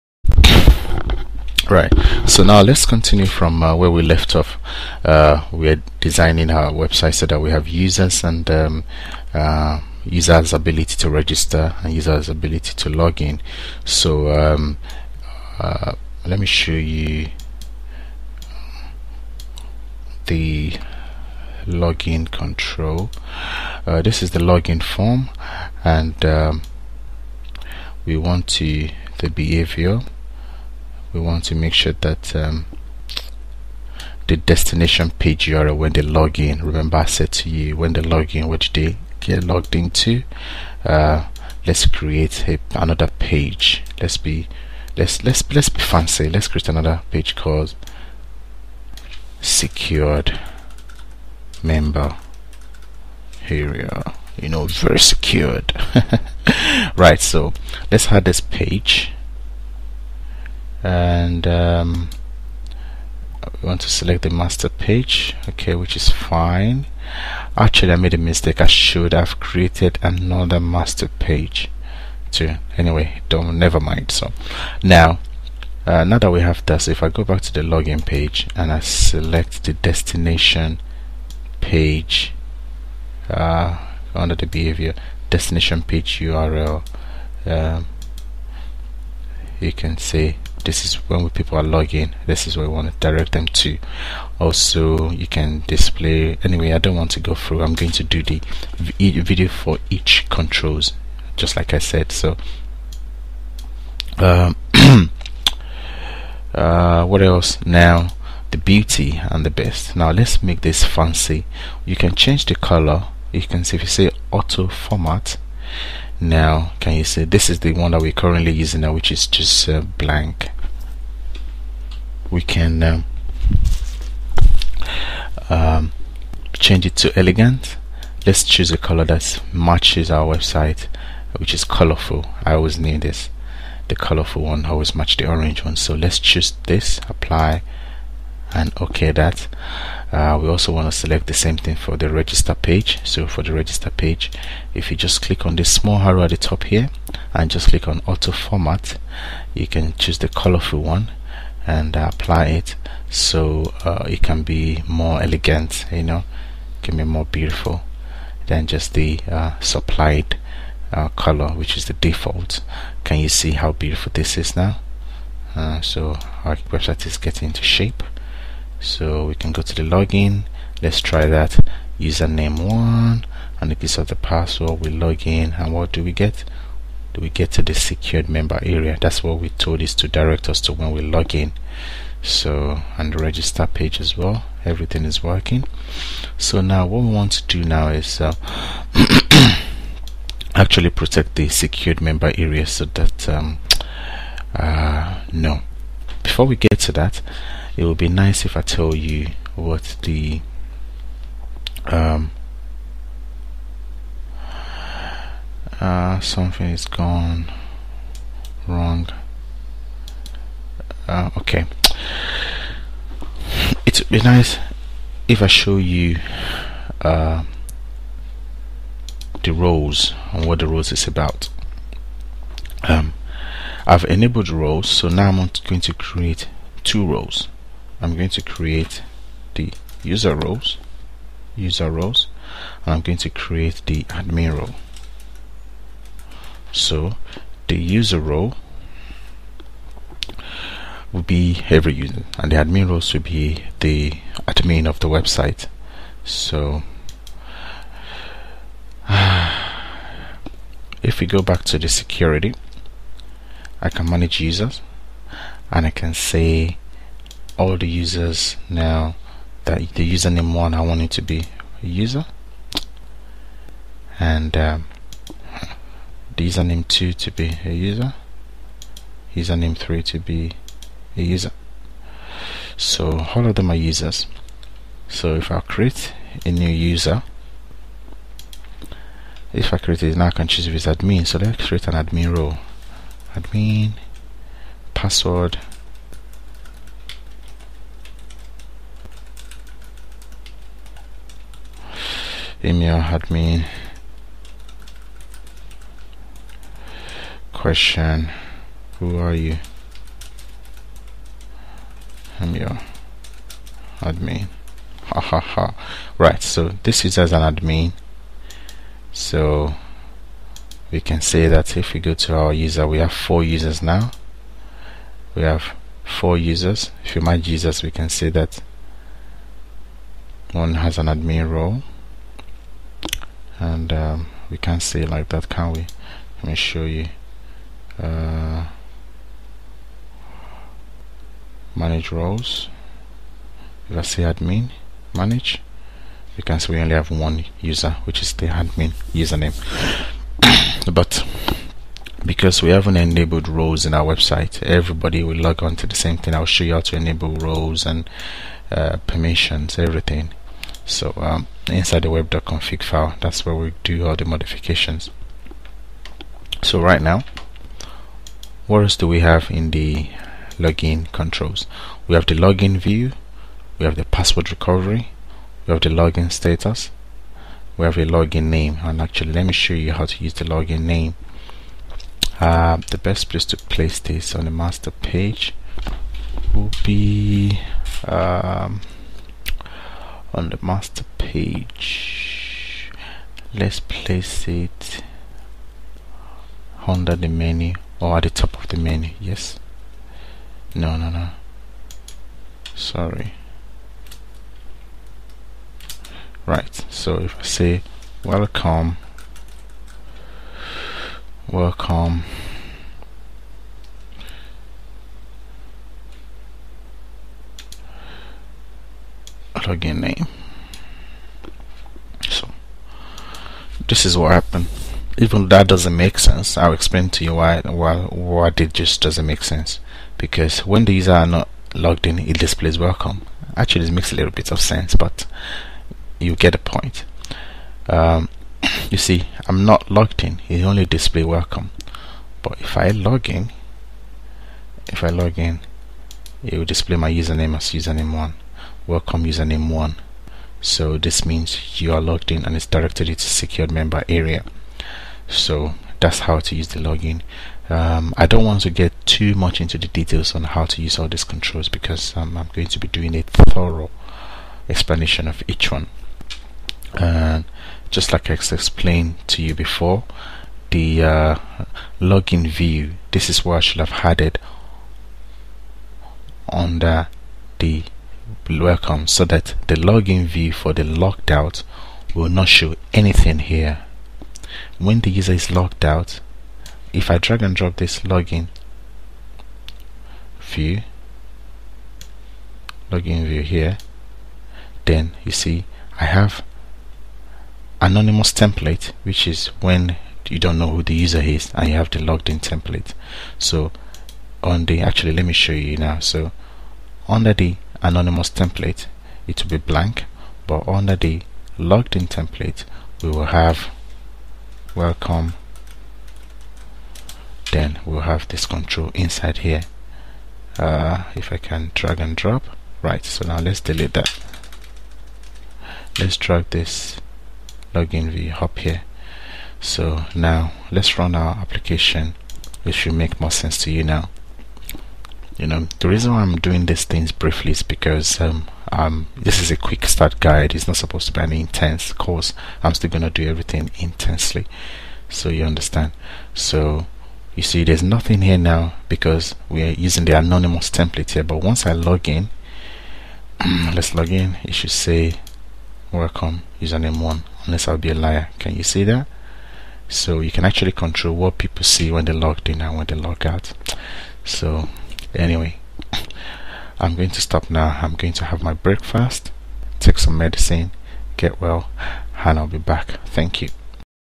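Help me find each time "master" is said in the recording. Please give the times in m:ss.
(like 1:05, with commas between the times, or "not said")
1:04, 1:10, 6:14, 6:20.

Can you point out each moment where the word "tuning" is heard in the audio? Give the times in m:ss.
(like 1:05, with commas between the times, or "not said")
not said.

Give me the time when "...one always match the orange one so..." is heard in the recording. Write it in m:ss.
2:14.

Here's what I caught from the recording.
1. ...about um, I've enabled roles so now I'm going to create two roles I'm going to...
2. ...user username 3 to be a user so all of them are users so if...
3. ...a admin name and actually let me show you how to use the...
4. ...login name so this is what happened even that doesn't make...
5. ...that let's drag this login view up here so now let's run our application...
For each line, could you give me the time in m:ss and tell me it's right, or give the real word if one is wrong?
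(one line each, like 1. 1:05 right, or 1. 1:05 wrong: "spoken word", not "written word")
1. 3:41 right
2. 4:27 right
3. 6:07 wrong: "login", not "admin"
4. 6:49 right
5. 8:33 right.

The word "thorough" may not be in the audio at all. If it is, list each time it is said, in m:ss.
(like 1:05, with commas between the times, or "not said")
7:33.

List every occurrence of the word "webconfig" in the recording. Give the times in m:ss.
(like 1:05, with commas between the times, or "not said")
5:52.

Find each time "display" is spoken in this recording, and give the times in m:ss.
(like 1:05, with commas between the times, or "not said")
1:35, 7:02, 7:10, 7:16.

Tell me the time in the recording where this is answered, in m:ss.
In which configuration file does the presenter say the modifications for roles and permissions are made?
5:52.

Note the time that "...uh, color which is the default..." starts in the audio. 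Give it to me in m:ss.
2:40.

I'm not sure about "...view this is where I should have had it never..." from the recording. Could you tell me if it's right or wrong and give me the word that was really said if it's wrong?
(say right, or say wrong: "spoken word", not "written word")
wrong: "under", not "never".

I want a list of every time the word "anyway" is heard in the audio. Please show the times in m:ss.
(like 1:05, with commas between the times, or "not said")
1:12, 1:36, 9:15.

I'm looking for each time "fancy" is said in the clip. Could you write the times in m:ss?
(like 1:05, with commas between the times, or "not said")
0:45, 1:50.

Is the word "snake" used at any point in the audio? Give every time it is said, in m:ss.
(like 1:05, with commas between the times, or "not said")
not said.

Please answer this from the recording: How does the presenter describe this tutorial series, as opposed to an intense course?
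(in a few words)
quick start guide.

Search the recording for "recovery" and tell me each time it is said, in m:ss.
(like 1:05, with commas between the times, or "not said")
6:04.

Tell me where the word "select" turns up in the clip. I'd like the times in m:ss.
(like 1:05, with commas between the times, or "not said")
1:03, 1:18, 2:20.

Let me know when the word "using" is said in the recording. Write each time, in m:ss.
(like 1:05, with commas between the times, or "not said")
1:58, 8:59.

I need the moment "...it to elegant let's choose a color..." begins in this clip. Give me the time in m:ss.
2:06.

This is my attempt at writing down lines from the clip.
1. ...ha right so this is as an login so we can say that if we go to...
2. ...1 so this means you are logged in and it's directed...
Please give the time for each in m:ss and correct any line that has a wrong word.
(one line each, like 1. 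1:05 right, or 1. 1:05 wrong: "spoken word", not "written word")
1. 5:05 wrong: "admin", not "login"
2. 7:19 right.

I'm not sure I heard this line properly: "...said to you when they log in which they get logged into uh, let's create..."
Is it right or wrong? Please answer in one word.
right.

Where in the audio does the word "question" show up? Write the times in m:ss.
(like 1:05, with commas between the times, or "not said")
4:57.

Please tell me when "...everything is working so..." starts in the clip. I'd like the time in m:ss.
3:04.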